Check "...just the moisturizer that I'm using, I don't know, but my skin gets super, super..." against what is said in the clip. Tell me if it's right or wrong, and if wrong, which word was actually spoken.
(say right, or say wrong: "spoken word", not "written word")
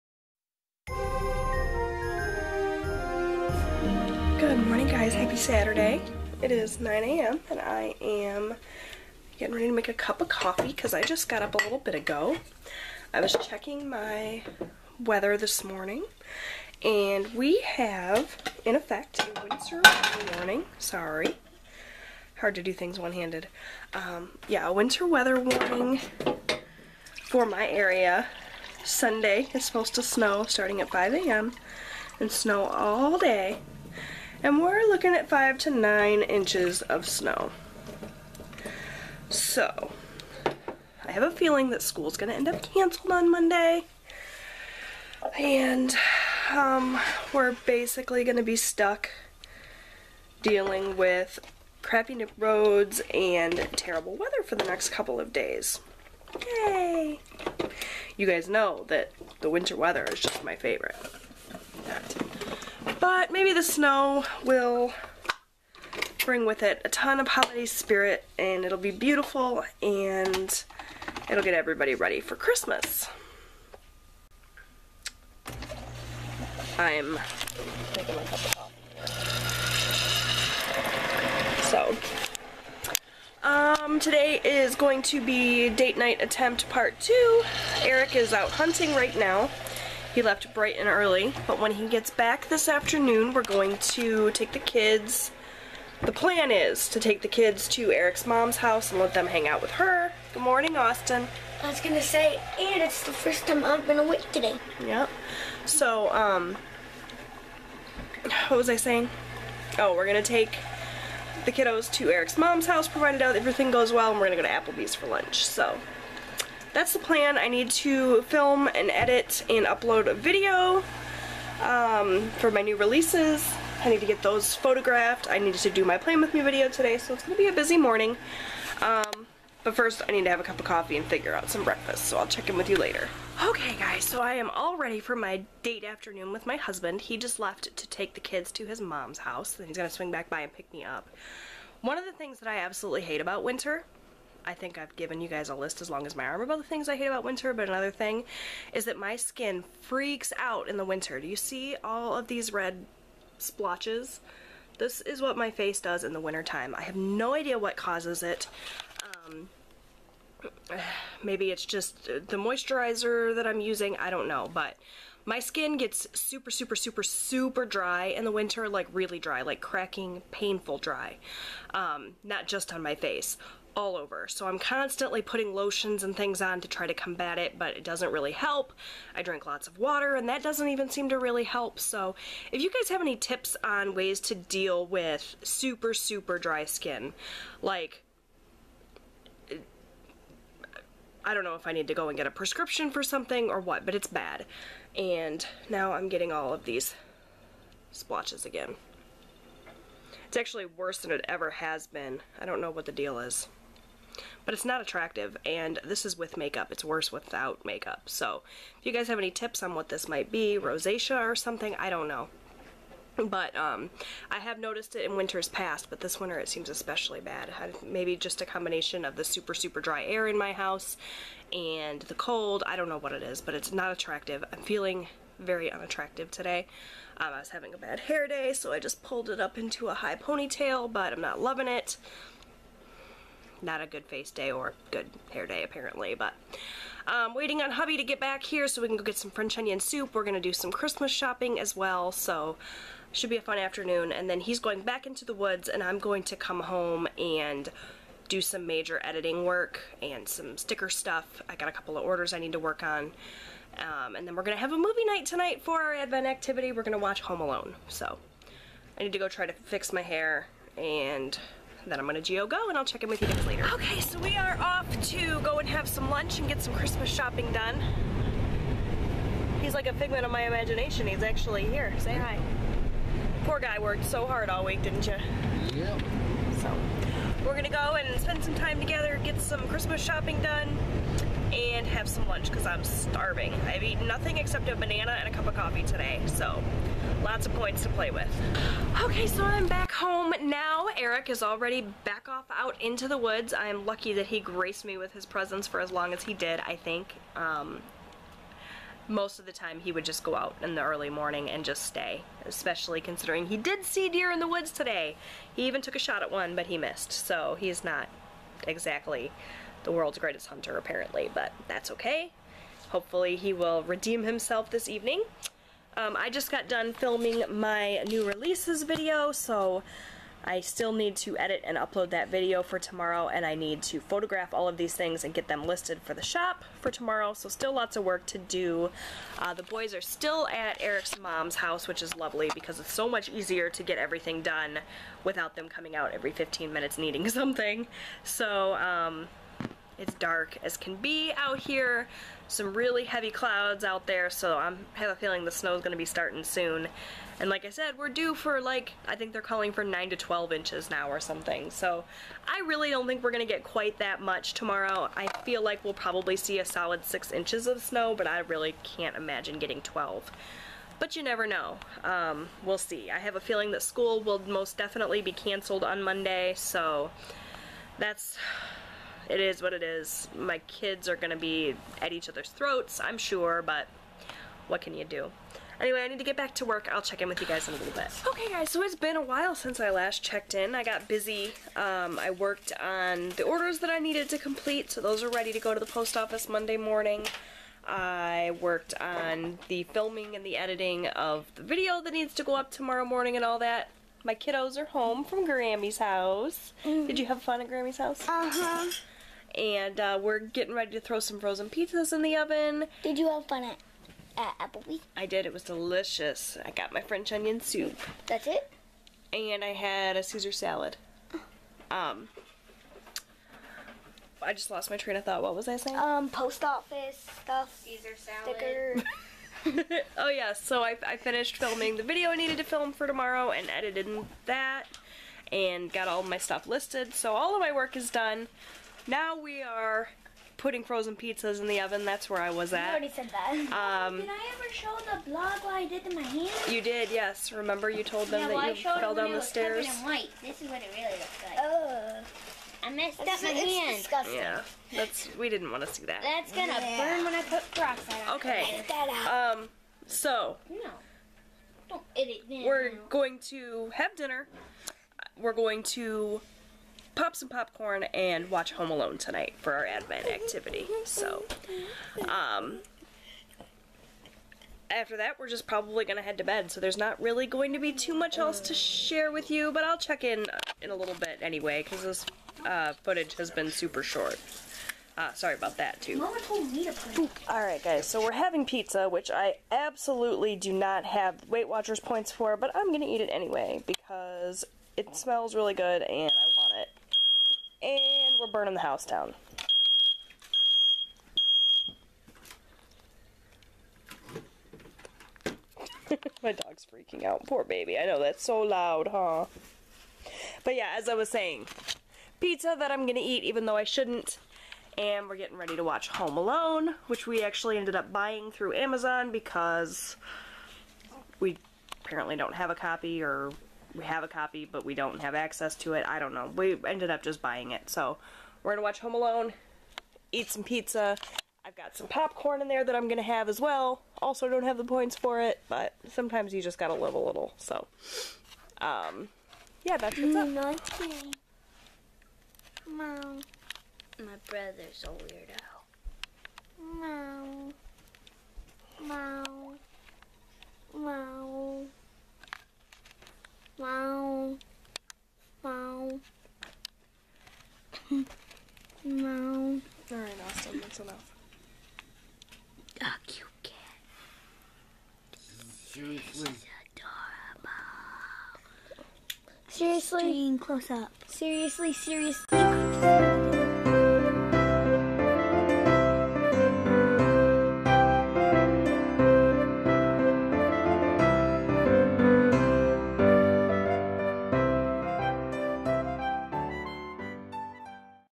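right.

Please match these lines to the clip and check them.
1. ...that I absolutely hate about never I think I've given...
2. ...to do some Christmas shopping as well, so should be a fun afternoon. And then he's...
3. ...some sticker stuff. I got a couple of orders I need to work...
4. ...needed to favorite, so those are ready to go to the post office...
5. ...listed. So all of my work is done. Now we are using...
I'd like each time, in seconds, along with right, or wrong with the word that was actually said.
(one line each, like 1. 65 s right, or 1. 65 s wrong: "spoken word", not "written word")
1. 142 s wrong: "winter", not "never"
2. 240 s right
3. 250 s right
4. 383 s wrong: "complete", not "favorite"
5. 426 s wrong: "putting", not "using".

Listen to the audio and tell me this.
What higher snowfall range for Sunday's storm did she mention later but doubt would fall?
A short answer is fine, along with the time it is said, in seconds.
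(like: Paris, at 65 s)
9 to 12 inches, at 349 s.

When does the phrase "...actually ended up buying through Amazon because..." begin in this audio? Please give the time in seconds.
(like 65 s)
507 s.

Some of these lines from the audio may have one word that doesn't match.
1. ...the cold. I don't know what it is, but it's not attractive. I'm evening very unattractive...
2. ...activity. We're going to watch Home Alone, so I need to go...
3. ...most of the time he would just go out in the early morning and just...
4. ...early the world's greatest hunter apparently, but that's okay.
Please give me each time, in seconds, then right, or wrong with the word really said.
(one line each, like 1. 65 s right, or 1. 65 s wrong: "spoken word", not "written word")
1. 222 s wrong: "feeling", not "evening"
2. 256 s right
3. 299 s right
4. 308 s wrong: "exactly", not "early".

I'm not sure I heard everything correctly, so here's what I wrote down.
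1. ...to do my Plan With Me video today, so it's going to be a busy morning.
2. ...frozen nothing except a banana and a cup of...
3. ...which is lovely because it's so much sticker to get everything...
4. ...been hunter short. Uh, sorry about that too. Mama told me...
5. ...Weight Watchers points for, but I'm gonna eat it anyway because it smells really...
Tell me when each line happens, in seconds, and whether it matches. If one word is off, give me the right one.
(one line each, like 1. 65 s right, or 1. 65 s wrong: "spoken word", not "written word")
1. 125 s right
2. 283 s wrong: "eaten", not "frozen"
3. 331 s wrong: "easier", not "sticker"
4. 473 s wrong: "super", not "hunter"
5. 481 s right.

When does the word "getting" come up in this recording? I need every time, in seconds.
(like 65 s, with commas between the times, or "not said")
9 s, 196 s, 359 s, 400 s, 505 s.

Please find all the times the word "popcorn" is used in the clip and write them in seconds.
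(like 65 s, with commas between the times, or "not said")
457 s, 522 s.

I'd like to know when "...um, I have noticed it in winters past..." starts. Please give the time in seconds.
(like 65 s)
213 s.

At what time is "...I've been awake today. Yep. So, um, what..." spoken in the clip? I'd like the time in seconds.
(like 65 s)
103 s.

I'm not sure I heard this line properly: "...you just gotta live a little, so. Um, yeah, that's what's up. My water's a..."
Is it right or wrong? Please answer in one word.
wrong.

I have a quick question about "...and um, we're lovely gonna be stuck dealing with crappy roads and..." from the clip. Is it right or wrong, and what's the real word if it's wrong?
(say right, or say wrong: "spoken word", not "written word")
wrong: "basically", not "lovely".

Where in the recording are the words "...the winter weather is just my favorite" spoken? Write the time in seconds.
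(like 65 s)
59 s.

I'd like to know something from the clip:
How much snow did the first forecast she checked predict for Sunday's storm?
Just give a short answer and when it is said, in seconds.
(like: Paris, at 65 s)
5 to 9 inches, at 35 s.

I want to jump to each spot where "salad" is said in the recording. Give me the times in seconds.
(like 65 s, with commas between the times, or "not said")
410 s, 418 s.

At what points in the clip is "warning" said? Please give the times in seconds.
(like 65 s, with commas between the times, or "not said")
20 s, 25 s.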